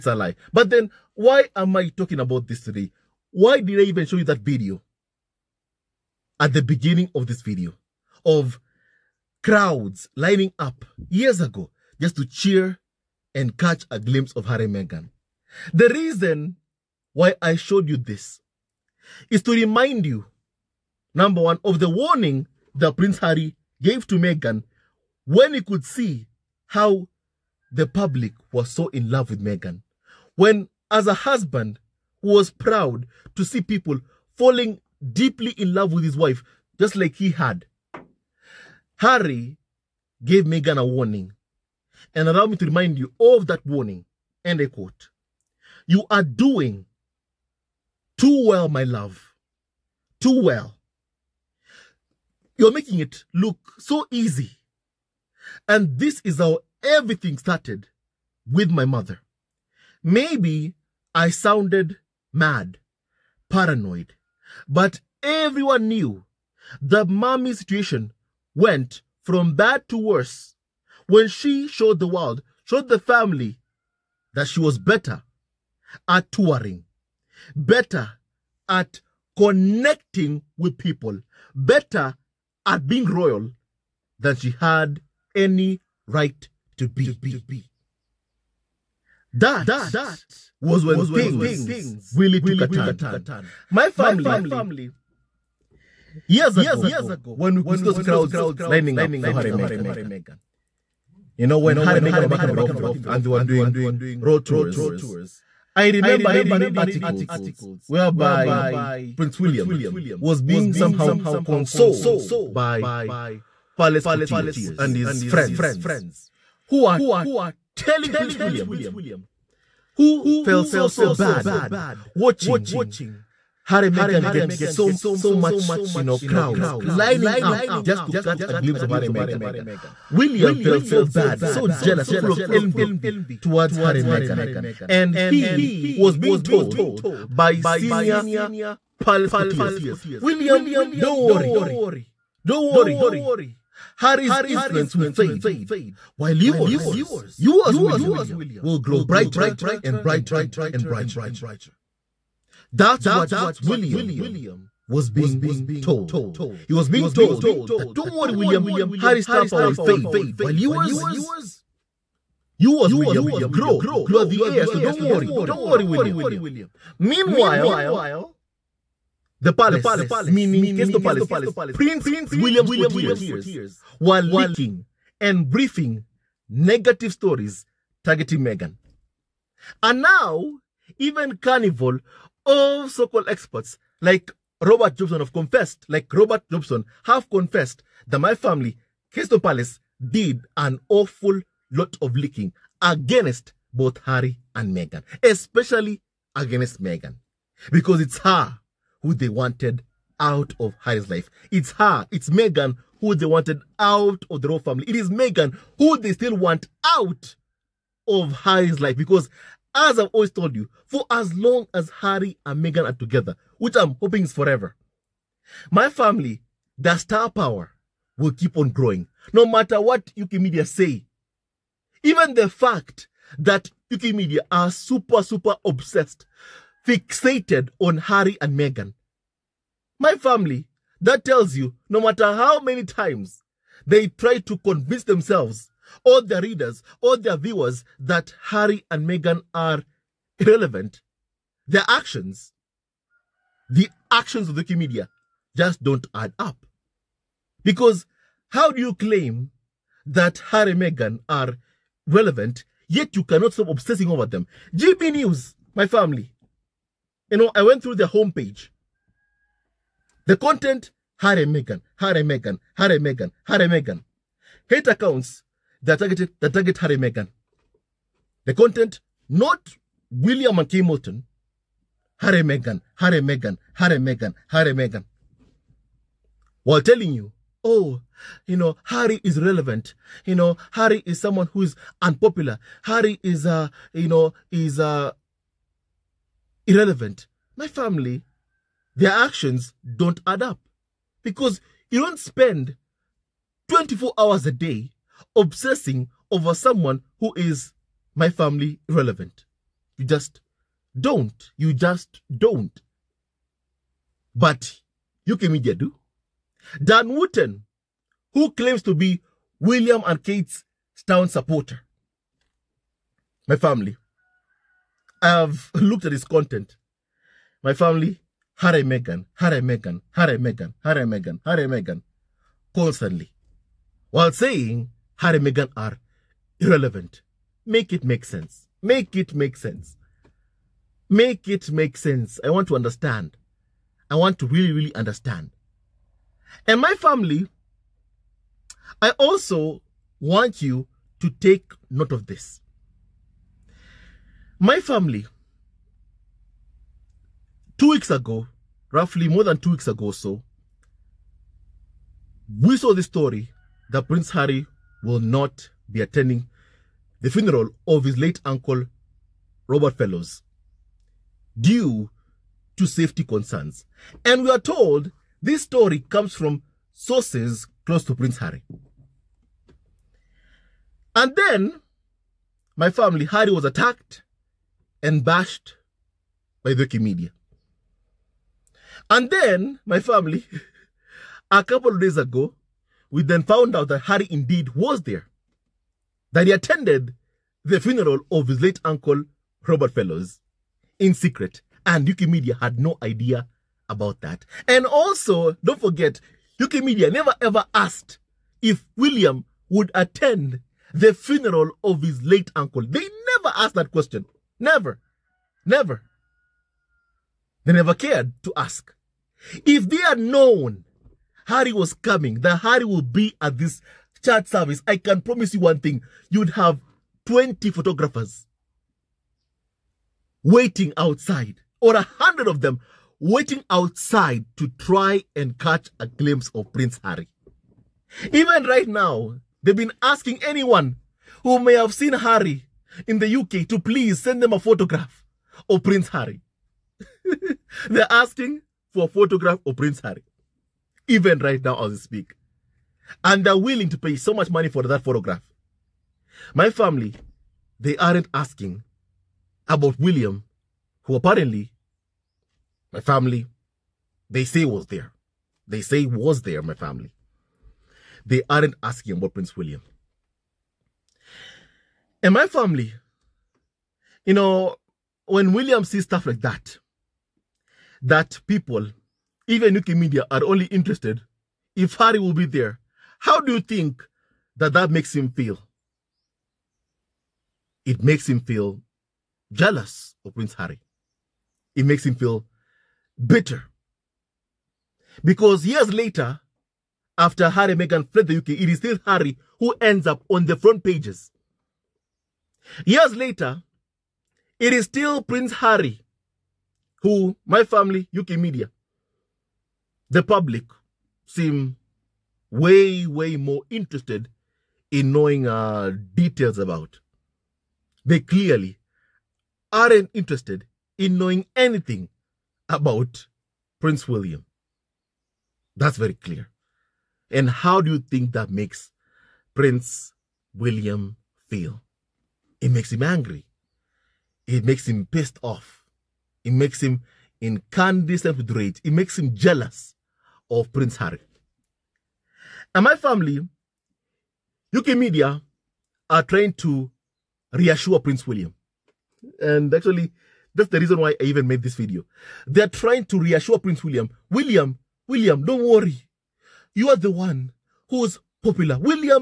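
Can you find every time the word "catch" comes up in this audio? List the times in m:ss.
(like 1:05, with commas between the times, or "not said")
0:13, 2:08, 7:05.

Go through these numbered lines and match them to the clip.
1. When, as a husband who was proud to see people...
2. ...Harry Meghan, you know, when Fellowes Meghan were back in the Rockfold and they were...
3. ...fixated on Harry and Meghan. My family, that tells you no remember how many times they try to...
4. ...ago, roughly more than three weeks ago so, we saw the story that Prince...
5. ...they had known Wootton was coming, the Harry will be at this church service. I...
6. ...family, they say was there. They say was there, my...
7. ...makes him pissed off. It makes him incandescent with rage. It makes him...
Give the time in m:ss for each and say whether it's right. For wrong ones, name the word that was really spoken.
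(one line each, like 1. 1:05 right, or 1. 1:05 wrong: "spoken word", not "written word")
1. 0:30 right
2. 1:39 wrong: "Harry", not "Fellowes"
3. 3:46 wrong: "matter", not "remember"
4. 5:48 wrong: "two", not "three"
5. 6:49 wrong: "Harry", not "Wootton"
6. 7:33 right
7. 8:44 right.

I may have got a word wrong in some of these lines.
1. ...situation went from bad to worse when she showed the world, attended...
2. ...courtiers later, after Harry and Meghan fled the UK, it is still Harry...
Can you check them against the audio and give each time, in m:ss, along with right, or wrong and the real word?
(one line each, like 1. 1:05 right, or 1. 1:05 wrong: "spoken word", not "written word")
1. 1:07 wrong: "showed", not "attended"
2. 8:05 wrong: "years", not "courtiers".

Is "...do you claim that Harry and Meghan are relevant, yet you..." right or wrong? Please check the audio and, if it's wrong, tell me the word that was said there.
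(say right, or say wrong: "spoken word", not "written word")
right.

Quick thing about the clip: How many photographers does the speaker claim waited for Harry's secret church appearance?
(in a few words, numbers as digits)
100.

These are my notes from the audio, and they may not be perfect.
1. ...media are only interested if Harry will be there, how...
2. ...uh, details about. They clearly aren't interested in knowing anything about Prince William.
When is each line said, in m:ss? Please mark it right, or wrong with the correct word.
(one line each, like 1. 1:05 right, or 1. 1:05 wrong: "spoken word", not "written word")
1. 7:49 right
2. 8:25 right.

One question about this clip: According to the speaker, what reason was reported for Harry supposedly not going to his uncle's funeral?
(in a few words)
safety concerns.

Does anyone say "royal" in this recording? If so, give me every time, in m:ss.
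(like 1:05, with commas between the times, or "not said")
1:23, 3:24.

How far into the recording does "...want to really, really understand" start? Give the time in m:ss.
5:34.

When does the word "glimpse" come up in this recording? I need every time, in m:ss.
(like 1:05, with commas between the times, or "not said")
0:13, 2:08, 7:06.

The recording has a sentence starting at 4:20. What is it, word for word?
The content, Harry and Meghan, Harry and Meghan, Harry and Meghan, Harry and Meghan.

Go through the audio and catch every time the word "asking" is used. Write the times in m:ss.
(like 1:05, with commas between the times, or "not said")
7:10, 7:18, 7:28, 7:38.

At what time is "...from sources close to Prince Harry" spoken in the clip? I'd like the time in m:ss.
6:06.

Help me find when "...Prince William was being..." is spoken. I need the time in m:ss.
1:49.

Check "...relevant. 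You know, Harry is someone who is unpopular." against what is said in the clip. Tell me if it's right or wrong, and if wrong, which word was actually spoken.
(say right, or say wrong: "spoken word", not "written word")
right.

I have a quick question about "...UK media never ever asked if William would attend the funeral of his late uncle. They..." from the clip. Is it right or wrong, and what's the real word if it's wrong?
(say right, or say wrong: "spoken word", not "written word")
right.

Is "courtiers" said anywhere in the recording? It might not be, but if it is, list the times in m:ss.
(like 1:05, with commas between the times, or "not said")
1:54, 2:19, 2:52.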